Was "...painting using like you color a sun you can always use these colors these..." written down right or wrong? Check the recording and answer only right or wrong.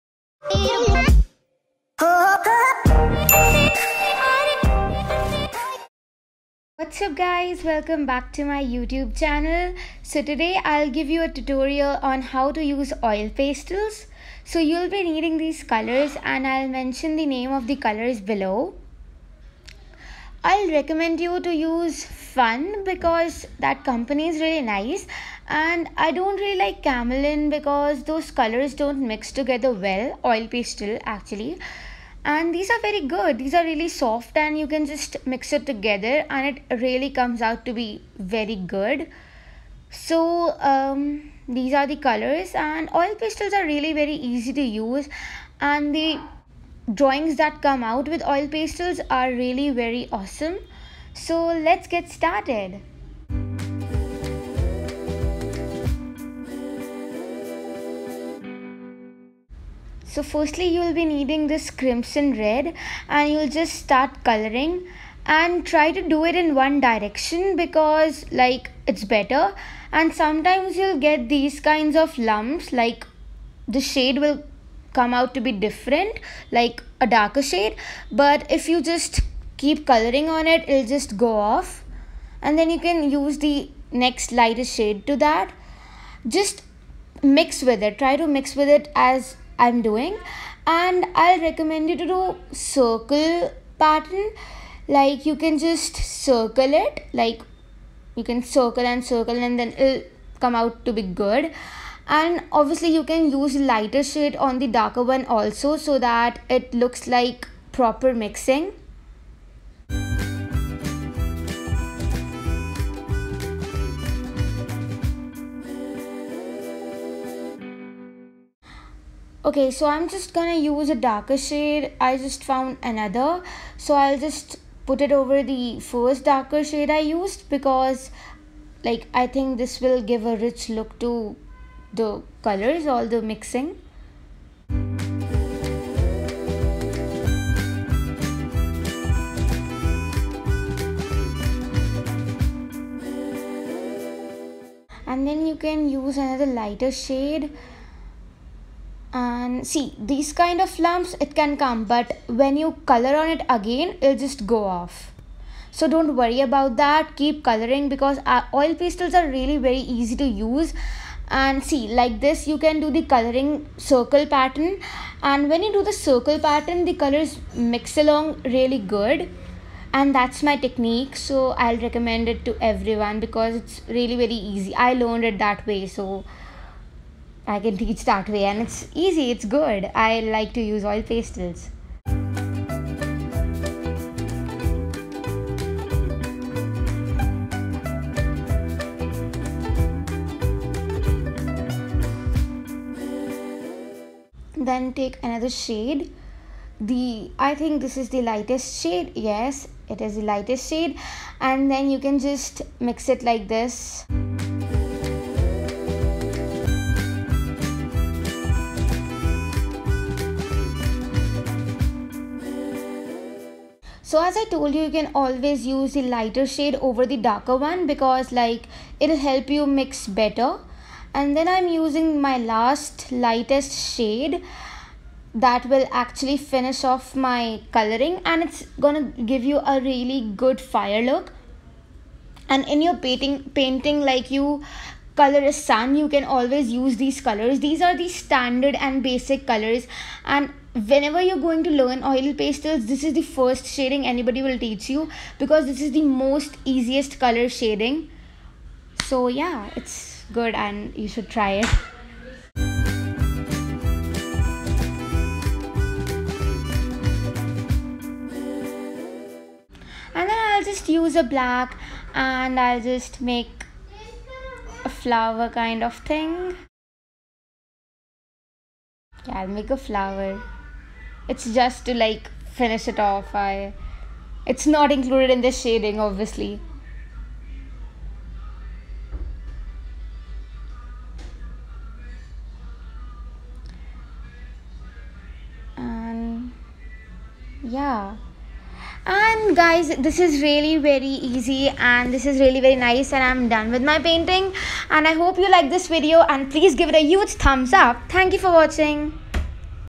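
wrong.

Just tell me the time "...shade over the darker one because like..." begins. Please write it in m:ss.
3:36.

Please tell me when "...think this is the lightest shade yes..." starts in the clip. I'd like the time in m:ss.
3:17.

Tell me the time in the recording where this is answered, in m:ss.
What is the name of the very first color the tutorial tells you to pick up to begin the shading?
1:01.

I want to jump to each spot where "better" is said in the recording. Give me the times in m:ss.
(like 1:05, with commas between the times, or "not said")
1:09, 3:40.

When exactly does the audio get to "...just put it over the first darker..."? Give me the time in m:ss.
2:04.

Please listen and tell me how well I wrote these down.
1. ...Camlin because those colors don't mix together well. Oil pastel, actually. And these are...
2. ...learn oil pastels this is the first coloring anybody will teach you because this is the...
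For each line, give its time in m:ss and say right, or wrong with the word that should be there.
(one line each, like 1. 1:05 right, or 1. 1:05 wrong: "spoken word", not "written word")
1. 0:26 right
2. 4:01 wrong: "shading", not "coloring".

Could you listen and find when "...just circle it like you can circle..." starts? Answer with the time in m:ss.
1:35.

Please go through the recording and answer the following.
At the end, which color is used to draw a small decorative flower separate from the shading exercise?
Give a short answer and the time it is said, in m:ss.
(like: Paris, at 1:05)
black, at 4:21.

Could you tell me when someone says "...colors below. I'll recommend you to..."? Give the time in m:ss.
0:17.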